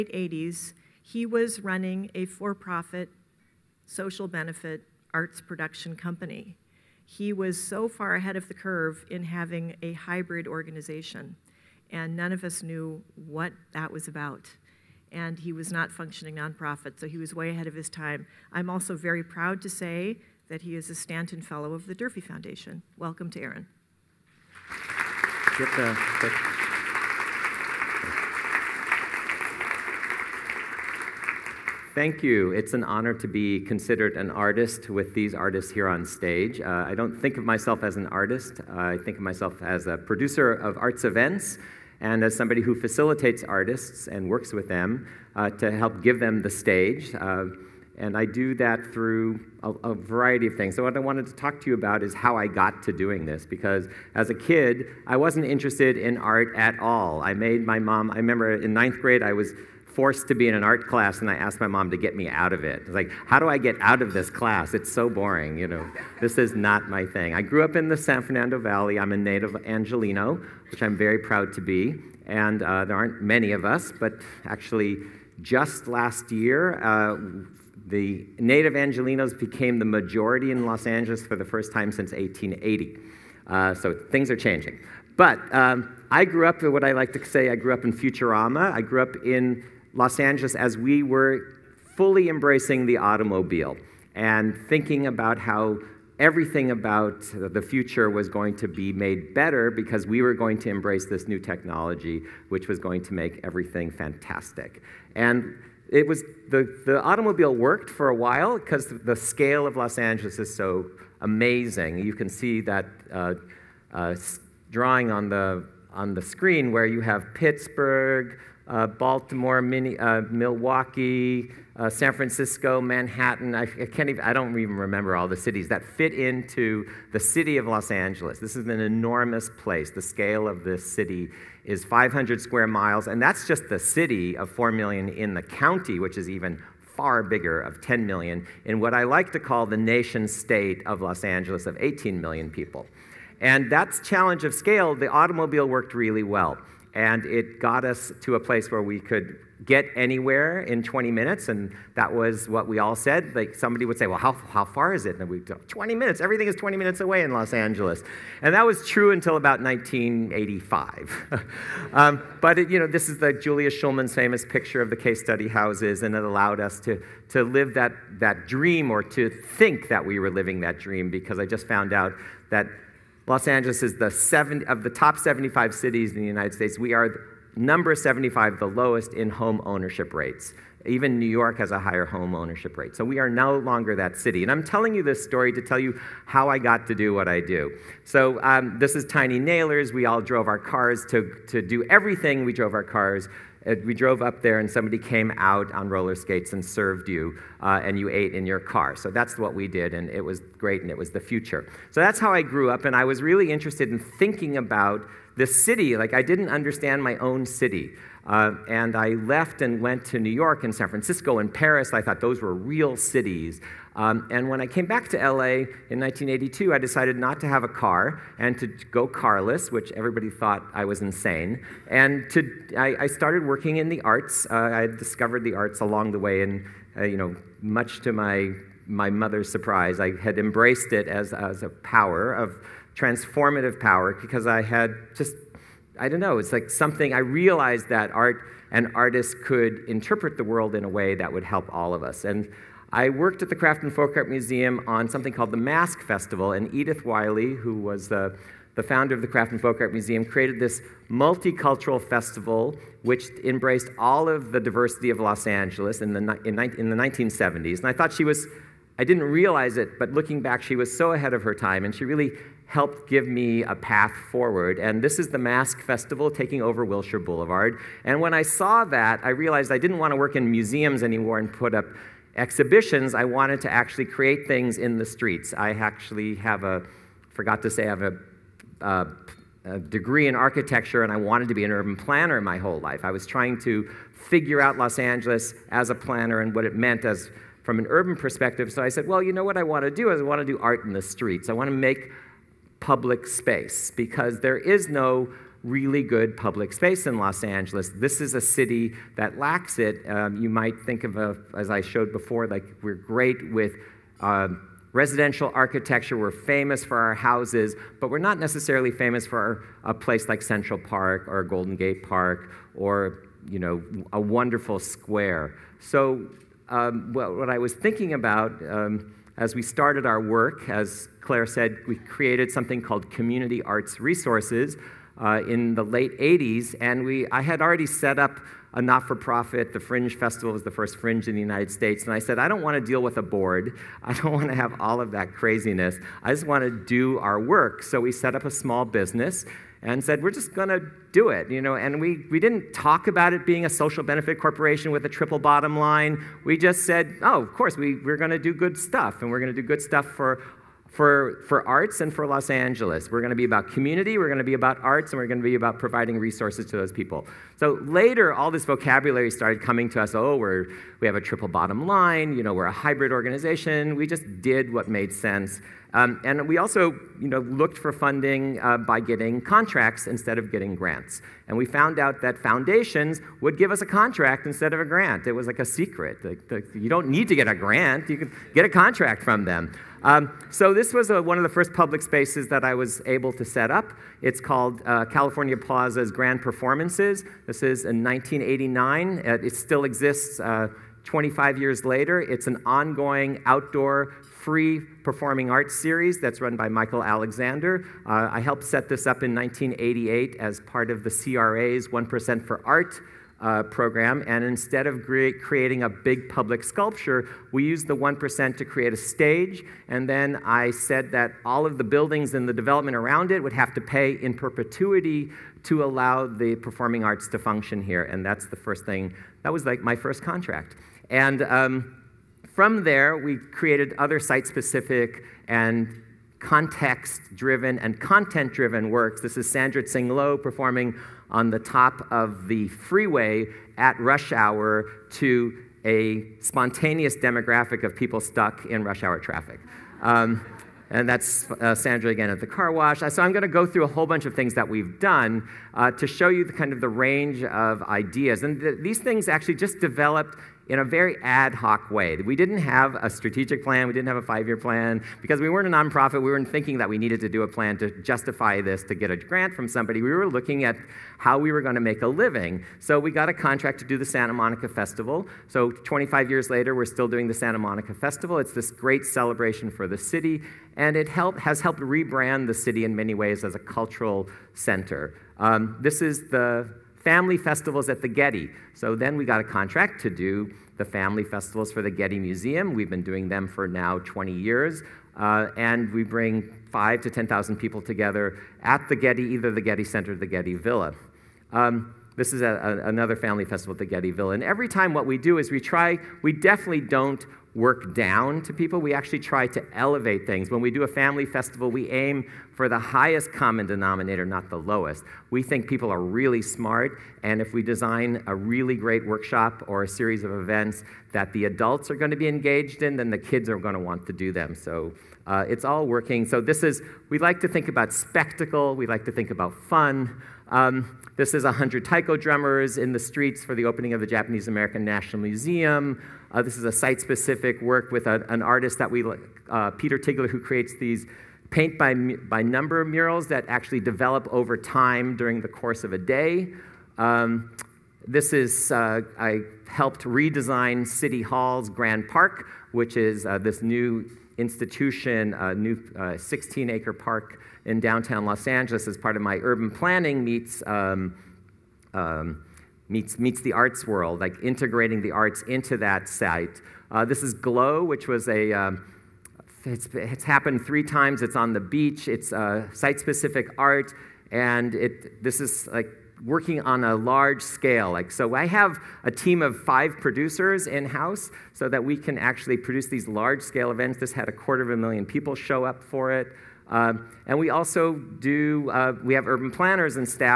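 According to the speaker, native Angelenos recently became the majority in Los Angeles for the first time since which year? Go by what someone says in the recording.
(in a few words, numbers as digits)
1880.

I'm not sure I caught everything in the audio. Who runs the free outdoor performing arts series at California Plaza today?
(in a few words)
Michael Alexander.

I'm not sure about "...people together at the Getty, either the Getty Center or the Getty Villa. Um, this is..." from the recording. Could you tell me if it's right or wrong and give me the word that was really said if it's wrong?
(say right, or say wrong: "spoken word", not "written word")
right.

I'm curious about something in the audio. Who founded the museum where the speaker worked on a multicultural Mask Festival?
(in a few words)
Edith Wyle.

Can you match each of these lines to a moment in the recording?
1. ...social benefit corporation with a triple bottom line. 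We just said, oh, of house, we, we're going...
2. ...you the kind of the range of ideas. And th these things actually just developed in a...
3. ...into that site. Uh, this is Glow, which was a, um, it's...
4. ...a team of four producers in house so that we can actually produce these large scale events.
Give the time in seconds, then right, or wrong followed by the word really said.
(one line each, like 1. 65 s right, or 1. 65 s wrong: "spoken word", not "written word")
1. 343 s wrong: "course", not "house"
2. 446 s right
3. 555 s right
4. 569 s wrong: "five", not "four".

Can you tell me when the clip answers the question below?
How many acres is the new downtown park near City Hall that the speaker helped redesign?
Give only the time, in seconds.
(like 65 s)
546 s.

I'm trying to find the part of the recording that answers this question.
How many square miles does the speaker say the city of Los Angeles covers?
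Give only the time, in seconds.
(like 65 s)
131 s.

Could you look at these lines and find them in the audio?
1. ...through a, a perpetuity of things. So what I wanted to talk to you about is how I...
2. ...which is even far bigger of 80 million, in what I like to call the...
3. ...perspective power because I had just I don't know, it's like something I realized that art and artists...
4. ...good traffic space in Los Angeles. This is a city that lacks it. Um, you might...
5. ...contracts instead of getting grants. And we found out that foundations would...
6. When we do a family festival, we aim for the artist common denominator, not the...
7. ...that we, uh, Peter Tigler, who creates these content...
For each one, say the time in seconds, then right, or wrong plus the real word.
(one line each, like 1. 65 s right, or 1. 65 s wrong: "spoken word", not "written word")
1. 48 s wrong: "variety", not "perpetuity"
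2. 135 s wrong: "10", not "80"
3. 232 s wrong: "transformative", not "perspective"
4. 296 s wrong: "public", not "traffic"
5. 369 s right
6. 500 s wrong: "highest", not "artist"
7. 528 s wrong: "paint", not "content".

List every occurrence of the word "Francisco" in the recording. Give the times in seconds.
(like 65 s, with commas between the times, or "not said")
122 s, 210 s.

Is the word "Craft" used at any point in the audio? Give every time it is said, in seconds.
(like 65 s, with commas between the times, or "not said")
243 s, 249 s.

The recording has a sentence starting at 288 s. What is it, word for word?
So I said, well, you know what I want to do is I want to do art in the streets.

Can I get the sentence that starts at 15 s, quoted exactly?
And he was not functioning nonprofit, so he was way ahead of his time.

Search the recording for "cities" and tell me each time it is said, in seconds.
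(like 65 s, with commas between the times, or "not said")
125 s, 175 s, 212 s.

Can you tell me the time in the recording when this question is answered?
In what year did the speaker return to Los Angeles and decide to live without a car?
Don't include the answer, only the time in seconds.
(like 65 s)
215 s.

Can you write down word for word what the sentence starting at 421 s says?
And um, from there, we created other site specific and context driven and content driven works.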